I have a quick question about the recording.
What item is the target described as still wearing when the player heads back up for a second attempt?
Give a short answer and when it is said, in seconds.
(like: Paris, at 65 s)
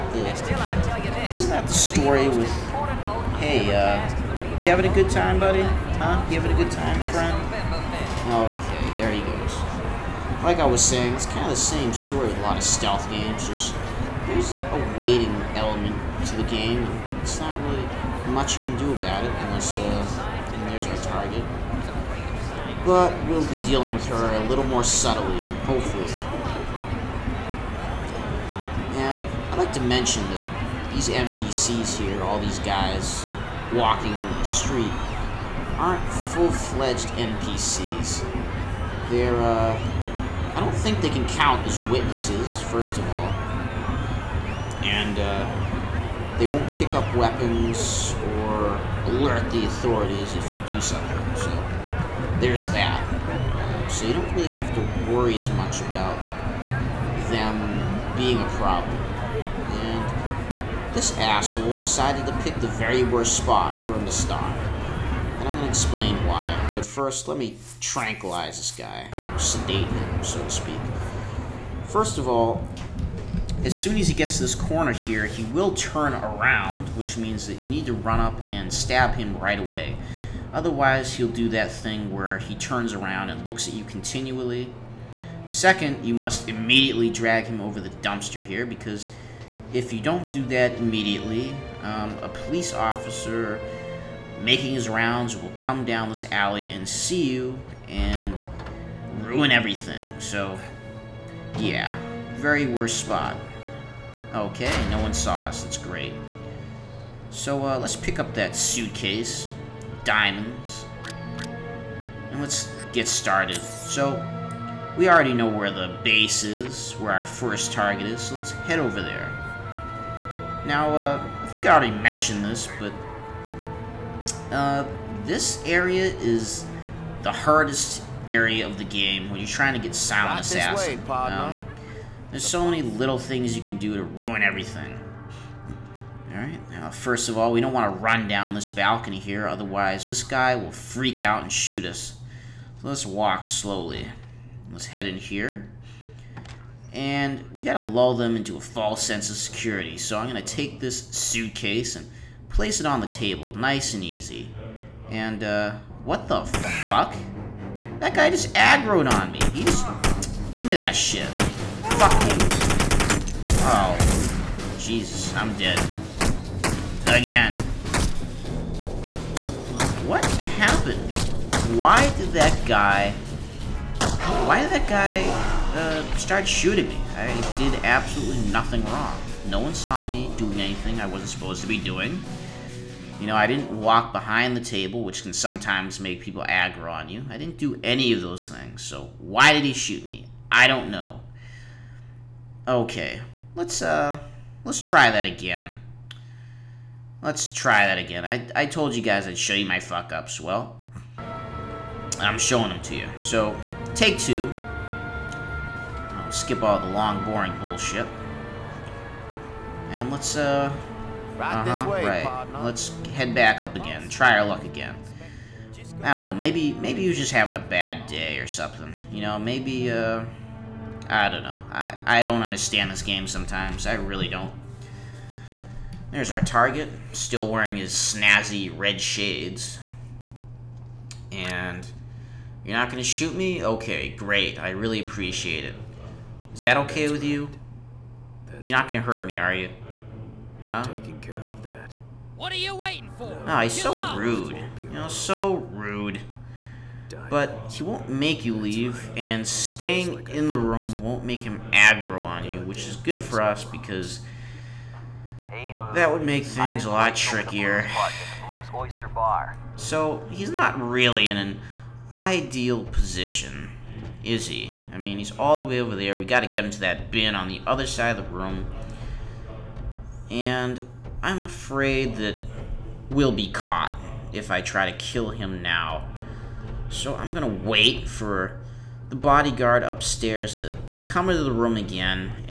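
Red shades, at 227 s.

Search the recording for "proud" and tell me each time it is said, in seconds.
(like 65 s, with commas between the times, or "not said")
not said.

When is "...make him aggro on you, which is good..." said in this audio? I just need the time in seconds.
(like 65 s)
251 s.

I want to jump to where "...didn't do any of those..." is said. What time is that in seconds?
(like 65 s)
187 s.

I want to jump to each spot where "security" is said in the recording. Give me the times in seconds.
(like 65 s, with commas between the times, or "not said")
149 s.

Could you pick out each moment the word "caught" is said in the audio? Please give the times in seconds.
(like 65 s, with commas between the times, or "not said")
273 s.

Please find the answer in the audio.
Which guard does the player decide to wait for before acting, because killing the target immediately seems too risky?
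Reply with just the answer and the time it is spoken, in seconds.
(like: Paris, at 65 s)
The bodyguard upstairs, at 279 s.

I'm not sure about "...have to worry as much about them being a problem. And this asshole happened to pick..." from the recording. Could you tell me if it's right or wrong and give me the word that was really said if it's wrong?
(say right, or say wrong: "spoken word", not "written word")
wrong: "decided", not "happened".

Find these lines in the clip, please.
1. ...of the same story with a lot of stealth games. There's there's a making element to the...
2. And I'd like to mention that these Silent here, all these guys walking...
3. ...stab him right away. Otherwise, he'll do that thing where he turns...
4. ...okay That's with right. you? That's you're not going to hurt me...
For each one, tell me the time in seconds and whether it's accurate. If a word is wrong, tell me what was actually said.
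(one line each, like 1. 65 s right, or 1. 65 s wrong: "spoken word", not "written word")
1. 11 s wrong: "waiting", not "making"
2. 28 s wrong: "NPCs", not "Silent"
3. 78 s right
4. 236 s right.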